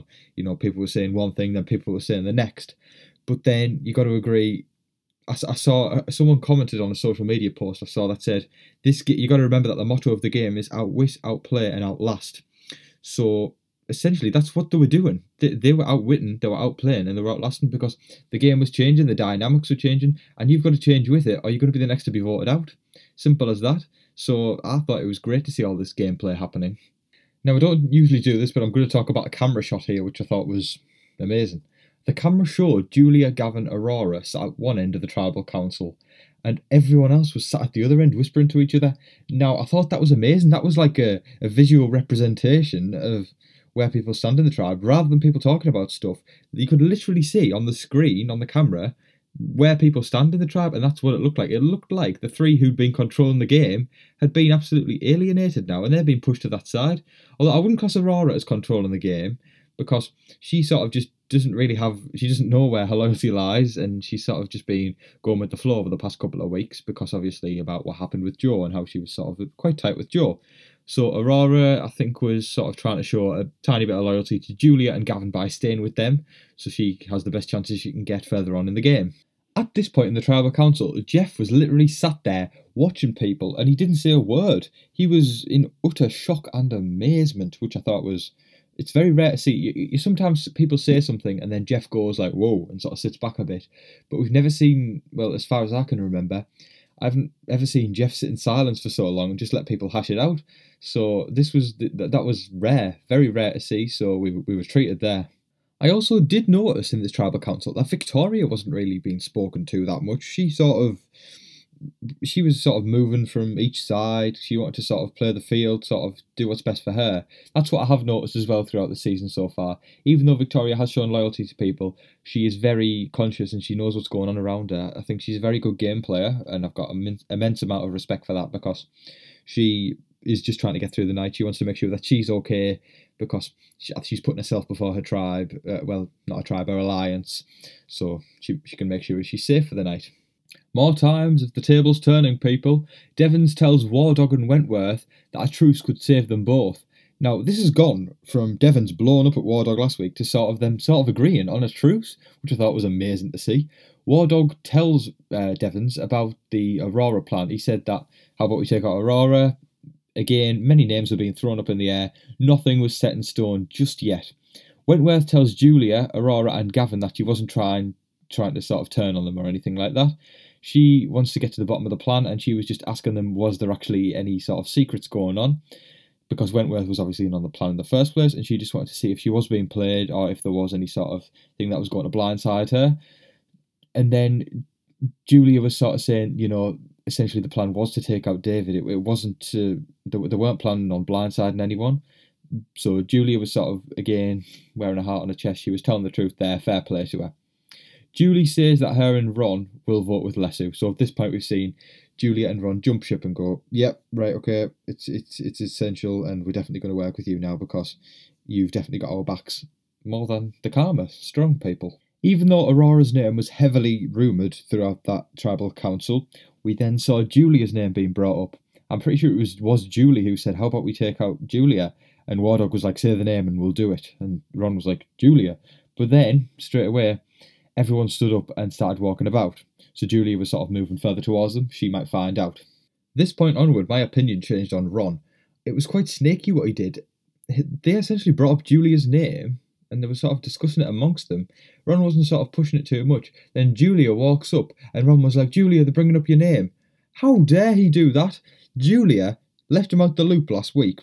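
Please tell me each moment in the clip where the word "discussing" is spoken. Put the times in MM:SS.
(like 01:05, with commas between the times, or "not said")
04:00.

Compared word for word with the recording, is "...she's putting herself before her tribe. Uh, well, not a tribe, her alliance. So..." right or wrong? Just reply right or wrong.
right.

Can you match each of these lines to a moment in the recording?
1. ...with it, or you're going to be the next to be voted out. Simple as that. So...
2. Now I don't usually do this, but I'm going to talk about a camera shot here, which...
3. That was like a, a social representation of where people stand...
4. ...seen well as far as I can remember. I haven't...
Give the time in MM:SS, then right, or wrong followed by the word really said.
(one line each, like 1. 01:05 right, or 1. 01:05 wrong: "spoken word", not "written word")
1. 00:21 right
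2. 00:27 right
3. 00:40 wrong: "visual", not "social"
4. 01:34 right.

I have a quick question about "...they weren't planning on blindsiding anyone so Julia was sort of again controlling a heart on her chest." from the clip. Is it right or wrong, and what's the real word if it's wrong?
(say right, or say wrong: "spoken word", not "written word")
wrong: "wearing", not "controlling".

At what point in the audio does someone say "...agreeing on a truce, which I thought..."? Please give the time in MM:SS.
02:31.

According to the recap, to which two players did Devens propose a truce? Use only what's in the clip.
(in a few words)
Wardog and Wentworth.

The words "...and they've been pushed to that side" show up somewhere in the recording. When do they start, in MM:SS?
00:55.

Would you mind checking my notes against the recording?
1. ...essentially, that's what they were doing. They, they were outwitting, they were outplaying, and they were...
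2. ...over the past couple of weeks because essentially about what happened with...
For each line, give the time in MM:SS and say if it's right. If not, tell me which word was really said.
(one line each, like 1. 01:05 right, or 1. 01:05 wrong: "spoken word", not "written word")
1. 00:13 right
2. 01:05 wrong: "obviously", not "essentially".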